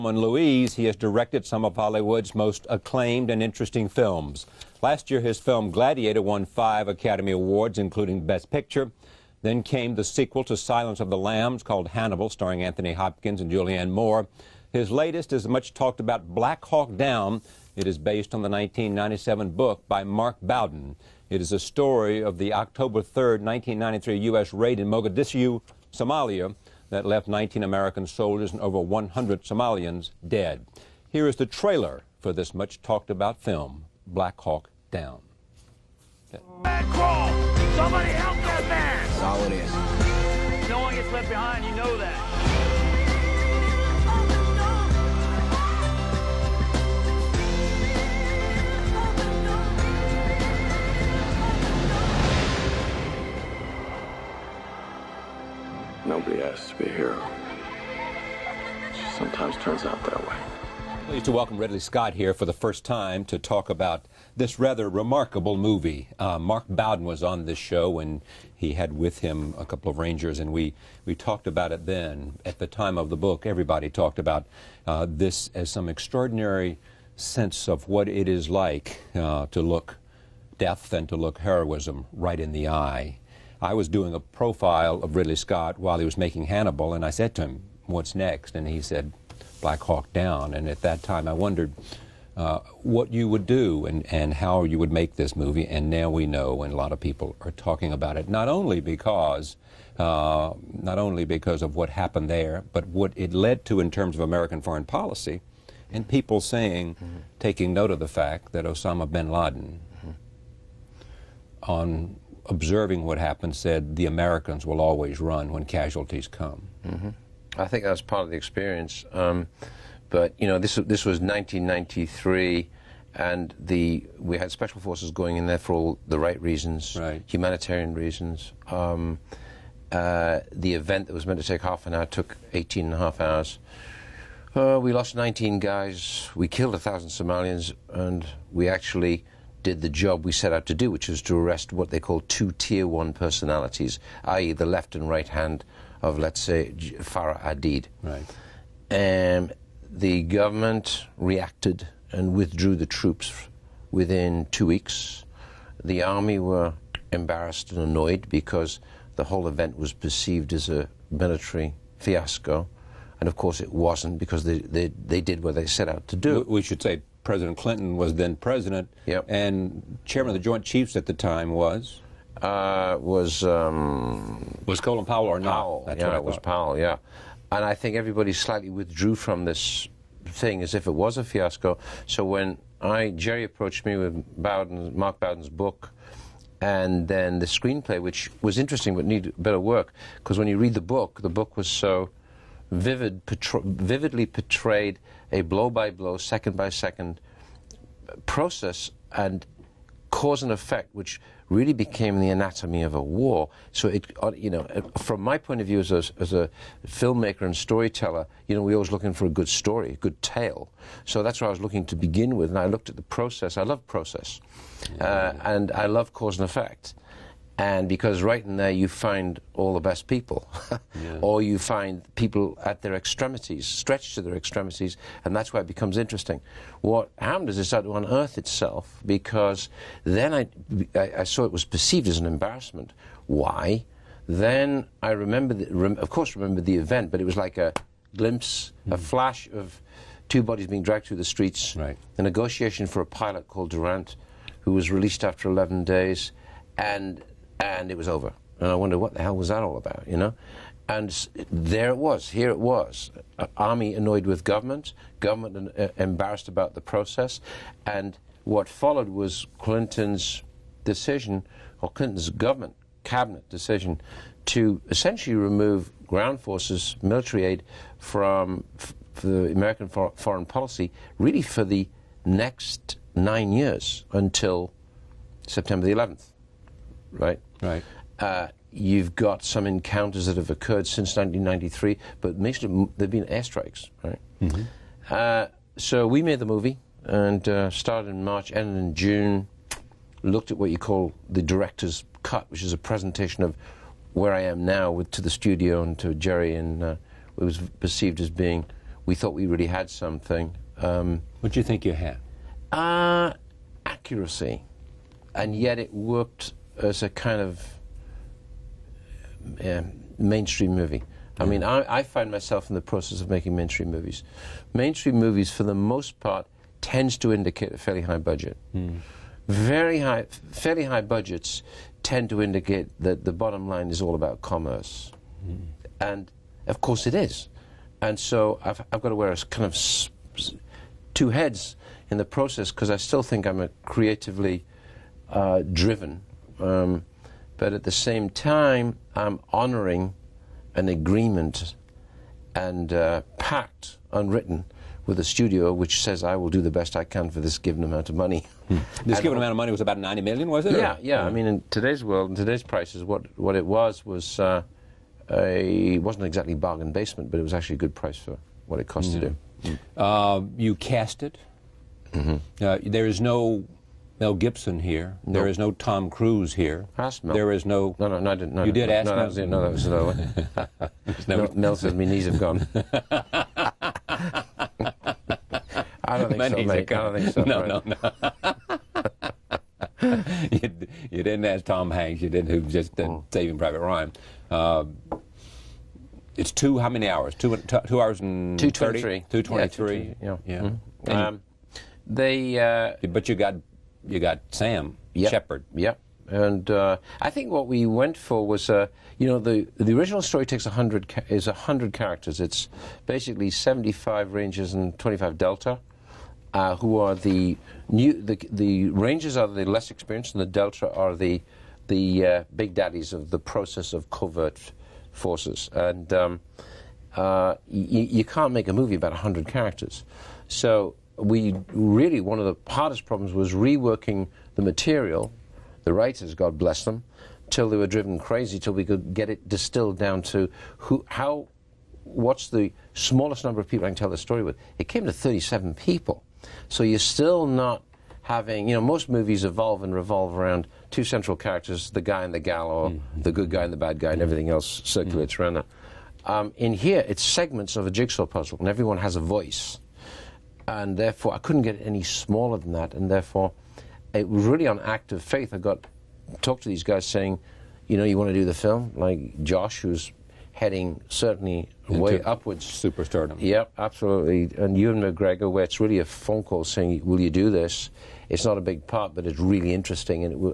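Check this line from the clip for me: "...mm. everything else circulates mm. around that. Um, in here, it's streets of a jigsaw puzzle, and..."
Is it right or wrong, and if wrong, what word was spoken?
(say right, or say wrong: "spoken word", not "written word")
wrong: "segments", not "streets".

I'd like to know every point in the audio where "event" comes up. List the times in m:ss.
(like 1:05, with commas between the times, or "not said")
2:10, 2:39, 3:56.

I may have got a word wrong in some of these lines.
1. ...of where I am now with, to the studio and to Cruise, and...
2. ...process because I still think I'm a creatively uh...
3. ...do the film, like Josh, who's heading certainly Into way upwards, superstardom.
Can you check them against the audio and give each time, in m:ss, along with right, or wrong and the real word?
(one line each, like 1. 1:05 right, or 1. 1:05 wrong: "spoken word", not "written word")
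1. 4:53 wrong: "Jerry", not "Cruise"
2. 5:32 right
3. 7:38 right.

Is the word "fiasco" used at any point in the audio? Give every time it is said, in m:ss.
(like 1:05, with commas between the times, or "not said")
2:41, 3:01.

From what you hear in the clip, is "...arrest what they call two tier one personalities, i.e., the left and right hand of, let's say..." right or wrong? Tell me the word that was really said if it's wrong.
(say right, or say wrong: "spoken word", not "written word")
right.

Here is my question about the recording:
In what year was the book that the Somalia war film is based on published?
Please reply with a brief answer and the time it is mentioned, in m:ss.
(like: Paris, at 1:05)
1997, at 0:18.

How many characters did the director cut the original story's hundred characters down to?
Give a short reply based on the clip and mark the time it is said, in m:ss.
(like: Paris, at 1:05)
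37, at 7:15.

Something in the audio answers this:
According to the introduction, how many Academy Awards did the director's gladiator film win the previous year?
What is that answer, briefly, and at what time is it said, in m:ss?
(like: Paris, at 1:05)
5, at 0:06.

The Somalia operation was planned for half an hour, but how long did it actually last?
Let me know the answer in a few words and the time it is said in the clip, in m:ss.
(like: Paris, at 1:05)
18 and a half hours, at 2:12.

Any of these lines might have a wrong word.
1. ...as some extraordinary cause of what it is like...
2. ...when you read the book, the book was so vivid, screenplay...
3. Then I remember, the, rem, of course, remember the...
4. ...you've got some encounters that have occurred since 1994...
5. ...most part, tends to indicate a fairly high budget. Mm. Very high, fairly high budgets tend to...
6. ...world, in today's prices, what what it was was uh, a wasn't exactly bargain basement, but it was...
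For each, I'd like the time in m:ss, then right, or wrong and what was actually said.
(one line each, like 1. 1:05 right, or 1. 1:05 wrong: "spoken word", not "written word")
1. 1:15 wrong: "sense", not "cause"
2. 3:10 wrong: "portray", not "screenplay"
3. 3:54 right
4. 4:38 wrong: "1993", not "1994"
5. 5:15 right
6. 5:52 right.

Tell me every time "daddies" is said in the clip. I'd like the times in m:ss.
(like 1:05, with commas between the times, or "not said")
6:52.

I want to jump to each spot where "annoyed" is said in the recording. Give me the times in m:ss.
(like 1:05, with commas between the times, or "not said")
2:37, 4:13.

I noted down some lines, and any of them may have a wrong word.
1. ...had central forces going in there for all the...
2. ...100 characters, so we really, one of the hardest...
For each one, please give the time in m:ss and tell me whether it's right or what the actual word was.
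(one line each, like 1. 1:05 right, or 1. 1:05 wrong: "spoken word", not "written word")
1. 2:04 wrong: "special", not "central"
2. 6:59 right.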